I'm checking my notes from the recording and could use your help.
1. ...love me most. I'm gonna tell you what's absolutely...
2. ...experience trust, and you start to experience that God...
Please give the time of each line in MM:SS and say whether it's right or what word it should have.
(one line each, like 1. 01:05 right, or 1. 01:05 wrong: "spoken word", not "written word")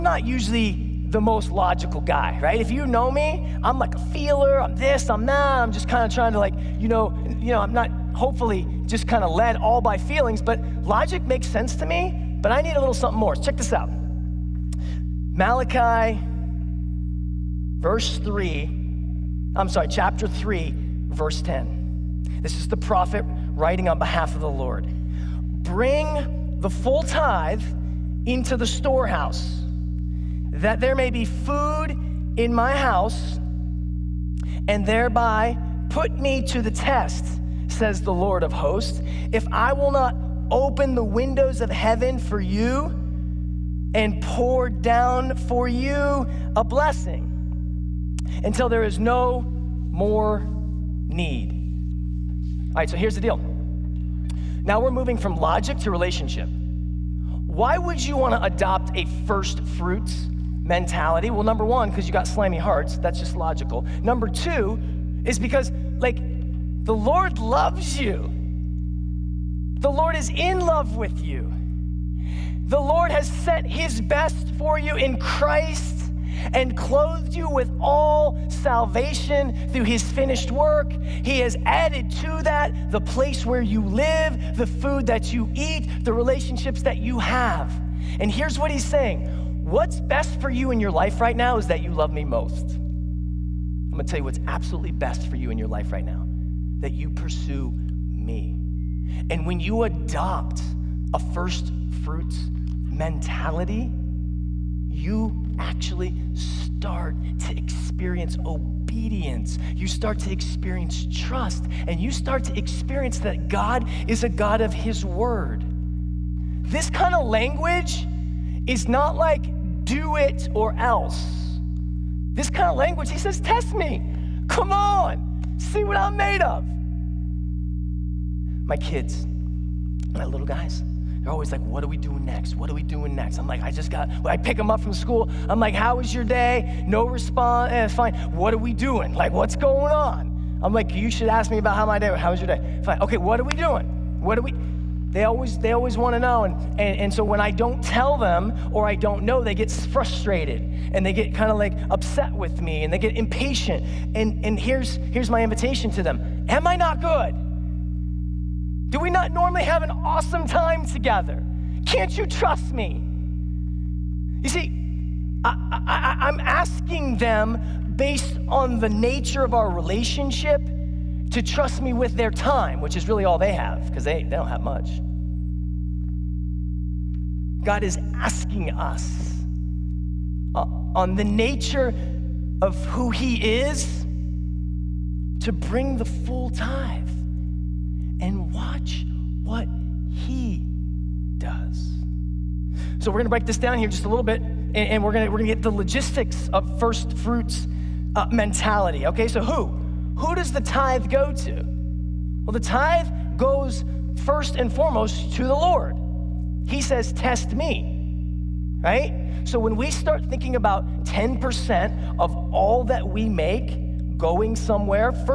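1. 01:31 right
2. 01:50 right.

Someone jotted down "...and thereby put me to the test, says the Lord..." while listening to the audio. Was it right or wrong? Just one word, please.
right.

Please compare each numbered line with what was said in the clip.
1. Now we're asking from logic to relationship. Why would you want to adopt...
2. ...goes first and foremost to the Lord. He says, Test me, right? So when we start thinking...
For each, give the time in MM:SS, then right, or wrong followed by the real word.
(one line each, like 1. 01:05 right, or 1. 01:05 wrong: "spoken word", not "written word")
1. 00:54 wrong: "moving", not "asking"
2. 03:23 right.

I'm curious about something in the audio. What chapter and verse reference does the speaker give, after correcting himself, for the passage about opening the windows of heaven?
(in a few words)
Chapter 3, verse 10.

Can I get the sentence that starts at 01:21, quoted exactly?
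He has added to that the place where you live, the food that you eat, the relationships that you have.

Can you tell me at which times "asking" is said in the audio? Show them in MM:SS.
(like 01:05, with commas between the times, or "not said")
02:46, 02:58.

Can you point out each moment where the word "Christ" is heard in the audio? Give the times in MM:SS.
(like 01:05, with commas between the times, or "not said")
01:15.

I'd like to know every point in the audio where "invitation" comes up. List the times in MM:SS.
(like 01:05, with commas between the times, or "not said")
02:35.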